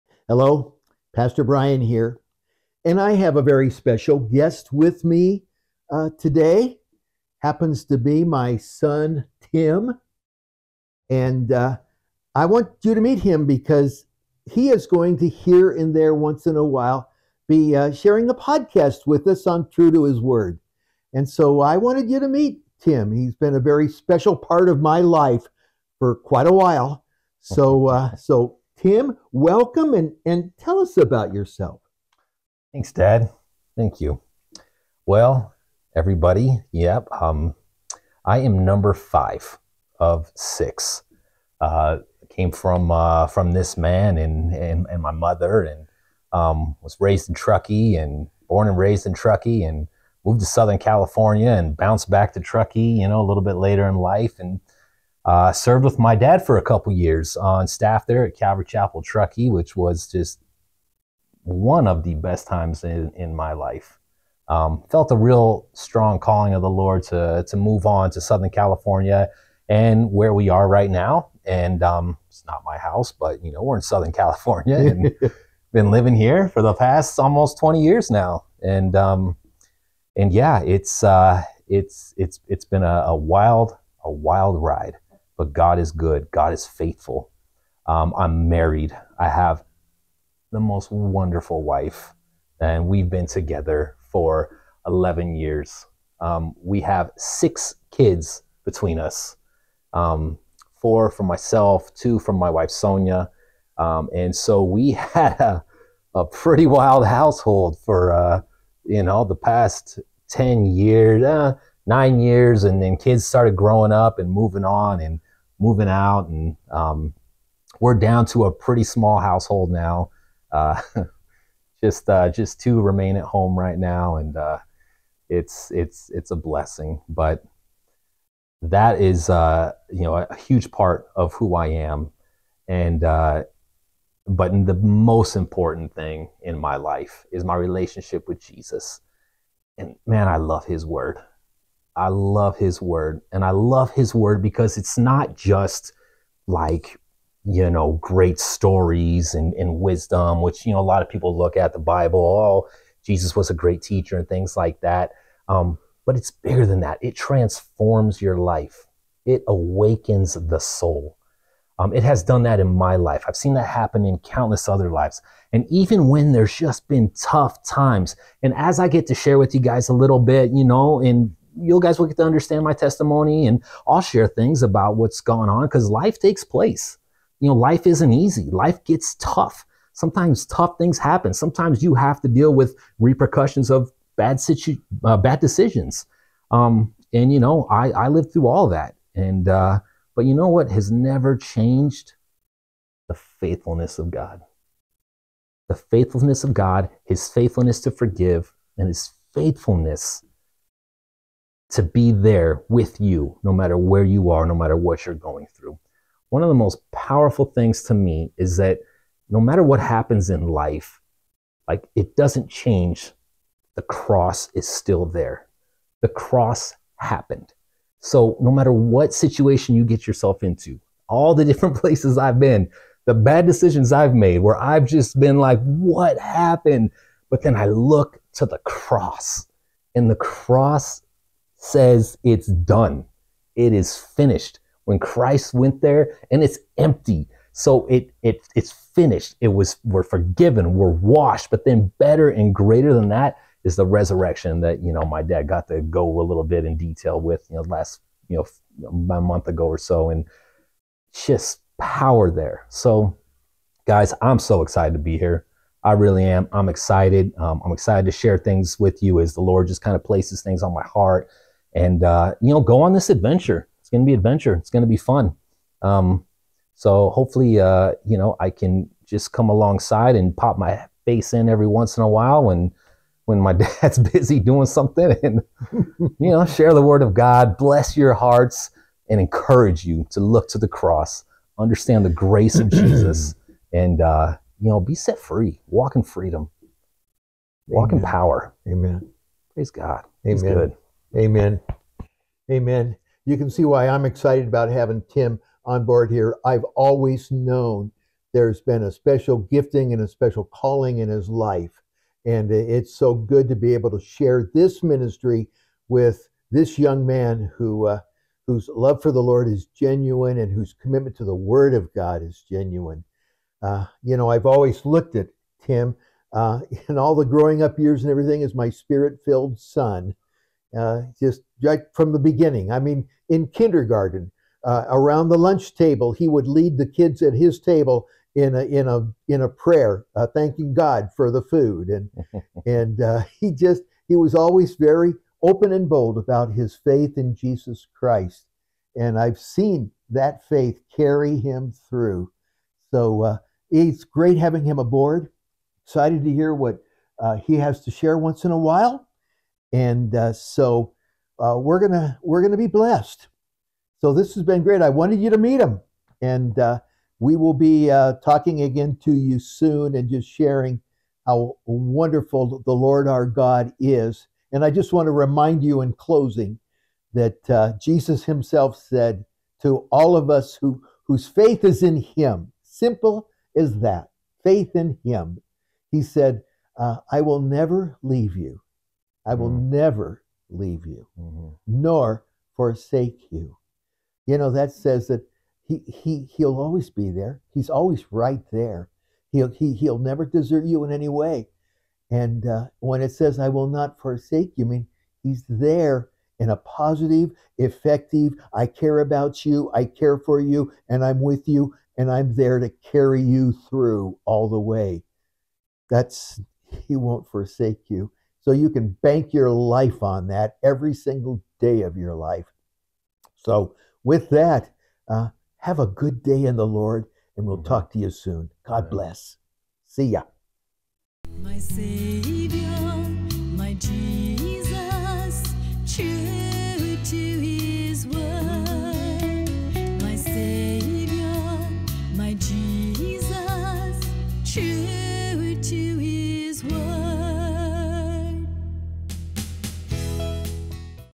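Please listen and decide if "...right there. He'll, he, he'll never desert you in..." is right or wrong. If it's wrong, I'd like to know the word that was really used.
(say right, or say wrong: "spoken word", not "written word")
right.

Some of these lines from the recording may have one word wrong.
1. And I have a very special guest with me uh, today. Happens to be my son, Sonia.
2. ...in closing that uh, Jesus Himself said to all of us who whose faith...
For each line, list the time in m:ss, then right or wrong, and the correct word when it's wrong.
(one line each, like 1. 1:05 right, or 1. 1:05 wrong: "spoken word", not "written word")
1. 0:02 wrong: "Tim", not "Sonia"
2. 6:05 right.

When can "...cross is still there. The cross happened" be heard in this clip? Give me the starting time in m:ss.
3:33.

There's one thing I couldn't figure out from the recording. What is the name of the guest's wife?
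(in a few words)
Sonia.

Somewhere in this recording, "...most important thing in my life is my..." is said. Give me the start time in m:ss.
2:14.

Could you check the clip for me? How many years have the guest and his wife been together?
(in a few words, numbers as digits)
11.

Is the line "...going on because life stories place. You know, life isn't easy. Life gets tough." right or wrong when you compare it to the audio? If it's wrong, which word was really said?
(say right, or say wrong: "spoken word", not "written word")
wrong: "takes", not "stories".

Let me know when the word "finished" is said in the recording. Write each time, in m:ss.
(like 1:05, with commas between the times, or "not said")
3:53, 3:58.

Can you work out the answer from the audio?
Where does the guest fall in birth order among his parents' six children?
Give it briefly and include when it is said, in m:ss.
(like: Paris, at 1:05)
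5, at 0:38.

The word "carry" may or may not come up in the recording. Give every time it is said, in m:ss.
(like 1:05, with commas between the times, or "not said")
5:40, 6:42.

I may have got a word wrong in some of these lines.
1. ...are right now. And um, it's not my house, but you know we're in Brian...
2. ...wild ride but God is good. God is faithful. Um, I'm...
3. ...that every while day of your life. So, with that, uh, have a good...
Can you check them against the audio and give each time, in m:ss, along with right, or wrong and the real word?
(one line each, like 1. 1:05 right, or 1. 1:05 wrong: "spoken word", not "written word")
1. 1:10 wrong: "Southern", not "Brian"
2. 1:24 right
3. 6:50 wrong: "single", not "while".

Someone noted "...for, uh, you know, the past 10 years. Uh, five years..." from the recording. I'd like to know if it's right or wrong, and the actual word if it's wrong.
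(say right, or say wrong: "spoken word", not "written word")
wrong: "nine", not "five".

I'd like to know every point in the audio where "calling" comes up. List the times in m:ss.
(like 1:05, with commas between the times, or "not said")
1:06, 5:00.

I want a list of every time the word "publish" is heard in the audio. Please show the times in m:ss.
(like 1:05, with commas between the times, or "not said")
not said.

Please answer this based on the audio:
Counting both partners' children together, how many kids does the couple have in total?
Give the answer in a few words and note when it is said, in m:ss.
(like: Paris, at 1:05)
6, at 1:37.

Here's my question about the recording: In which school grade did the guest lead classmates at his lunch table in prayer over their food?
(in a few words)
kindergarten.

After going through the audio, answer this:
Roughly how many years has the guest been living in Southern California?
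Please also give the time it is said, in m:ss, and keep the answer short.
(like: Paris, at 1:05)
almost 20, at 1:17.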